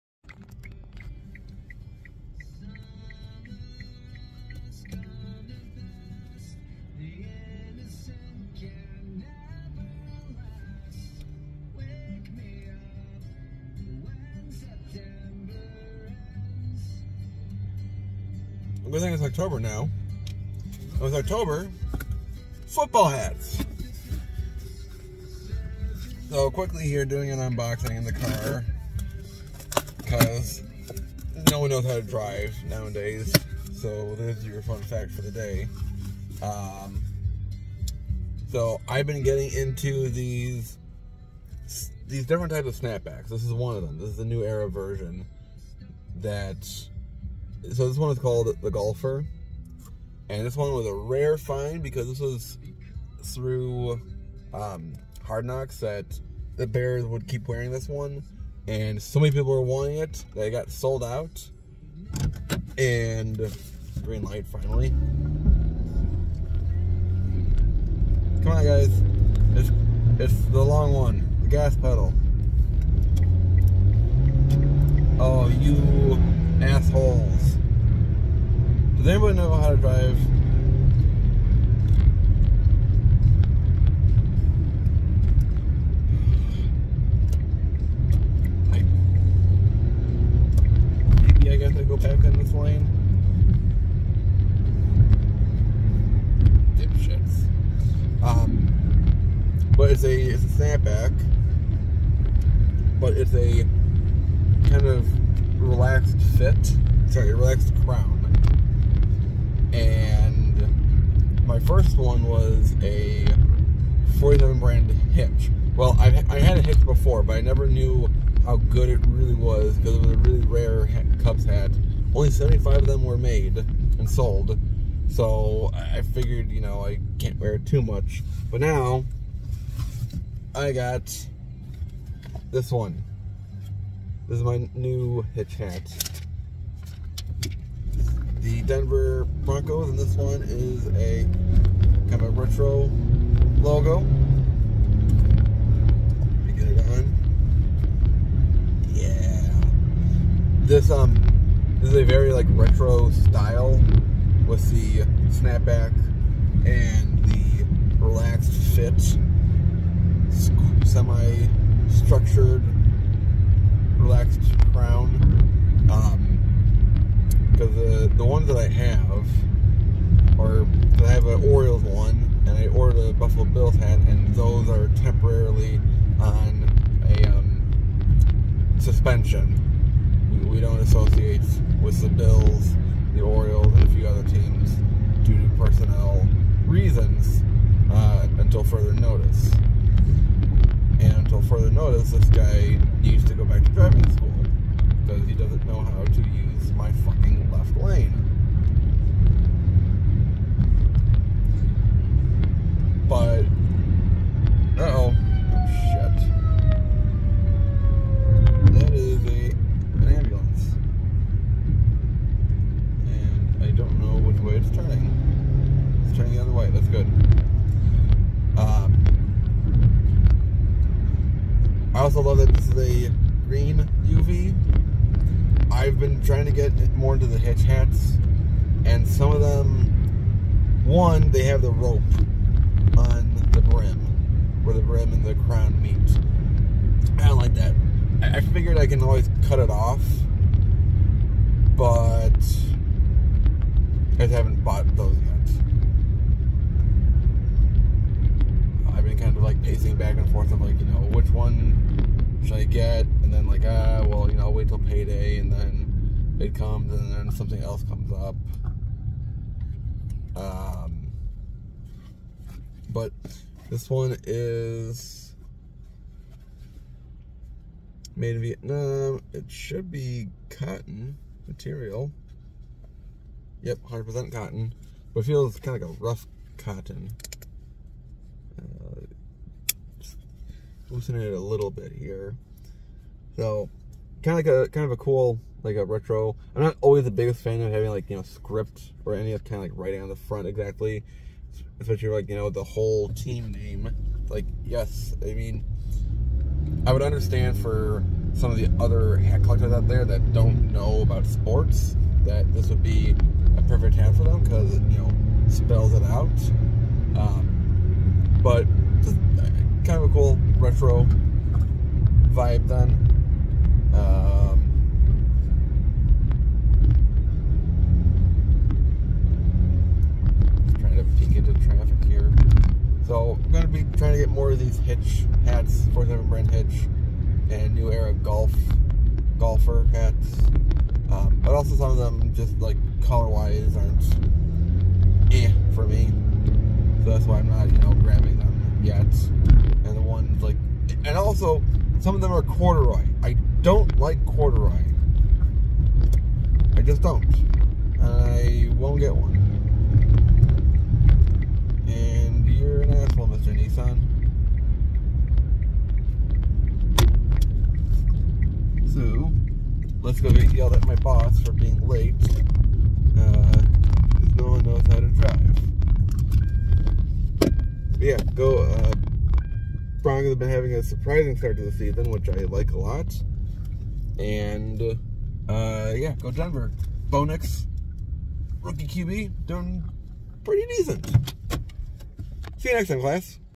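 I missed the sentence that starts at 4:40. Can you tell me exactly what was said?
loosening it a little bit here.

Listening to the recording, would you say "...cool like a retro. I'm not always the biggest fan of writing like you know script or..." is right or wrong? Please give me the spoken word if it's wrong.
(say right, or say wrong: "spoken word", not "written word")
wrong: "having", not "writing".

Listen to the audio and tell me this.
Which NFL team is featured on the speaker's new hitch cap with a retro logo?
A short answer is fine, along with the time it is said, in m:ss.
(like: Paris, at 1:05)
Denver Broncos, at 2:18.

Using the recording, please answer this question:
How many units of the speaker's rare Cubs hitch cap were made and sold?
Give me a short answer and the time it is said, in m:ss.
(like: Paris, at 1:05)
75, at 2:02.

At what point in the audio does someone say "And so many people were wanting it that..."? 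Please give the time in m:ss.
0:58.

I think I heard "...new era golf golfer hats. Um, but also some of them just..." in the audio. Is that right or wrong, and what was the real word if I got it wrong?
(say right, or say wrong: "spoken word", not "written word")
right.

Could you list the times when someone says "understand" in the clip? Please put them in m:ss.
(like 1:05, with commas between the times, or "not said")
4:57.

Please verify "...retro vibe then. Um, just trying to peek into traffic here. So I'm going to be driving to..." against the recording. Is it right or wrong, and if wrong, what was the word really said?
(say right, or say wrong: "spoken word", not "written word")
wrong: "trying", not "driving".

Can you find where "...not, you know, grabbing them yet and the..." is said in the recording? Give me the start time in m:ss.
5:37.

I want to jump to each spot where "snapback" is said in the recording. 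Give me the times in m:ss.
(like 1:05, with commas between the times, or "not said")
0:42, 1:40, 2:35.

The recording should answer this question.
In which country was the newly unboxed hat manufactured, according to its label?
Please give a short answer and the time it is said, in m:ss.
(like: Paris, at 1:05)
Vietnam, at 4:28.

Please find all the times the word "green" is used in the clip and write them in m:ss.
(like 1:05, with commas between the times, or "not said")
1:04, 3:43.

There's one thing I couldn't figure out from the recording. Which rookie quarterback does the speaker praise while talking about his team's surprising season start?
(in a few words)
Bo Nix.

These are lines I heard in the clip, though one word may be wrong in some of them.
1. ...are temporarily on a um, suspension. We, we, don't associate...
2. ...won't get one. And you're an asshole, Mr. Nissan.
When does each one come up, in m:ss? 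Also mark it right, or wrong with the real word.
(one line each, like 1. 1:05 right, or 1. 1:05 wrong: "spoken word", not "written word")
1. 2:54 right
2. 5:48 right.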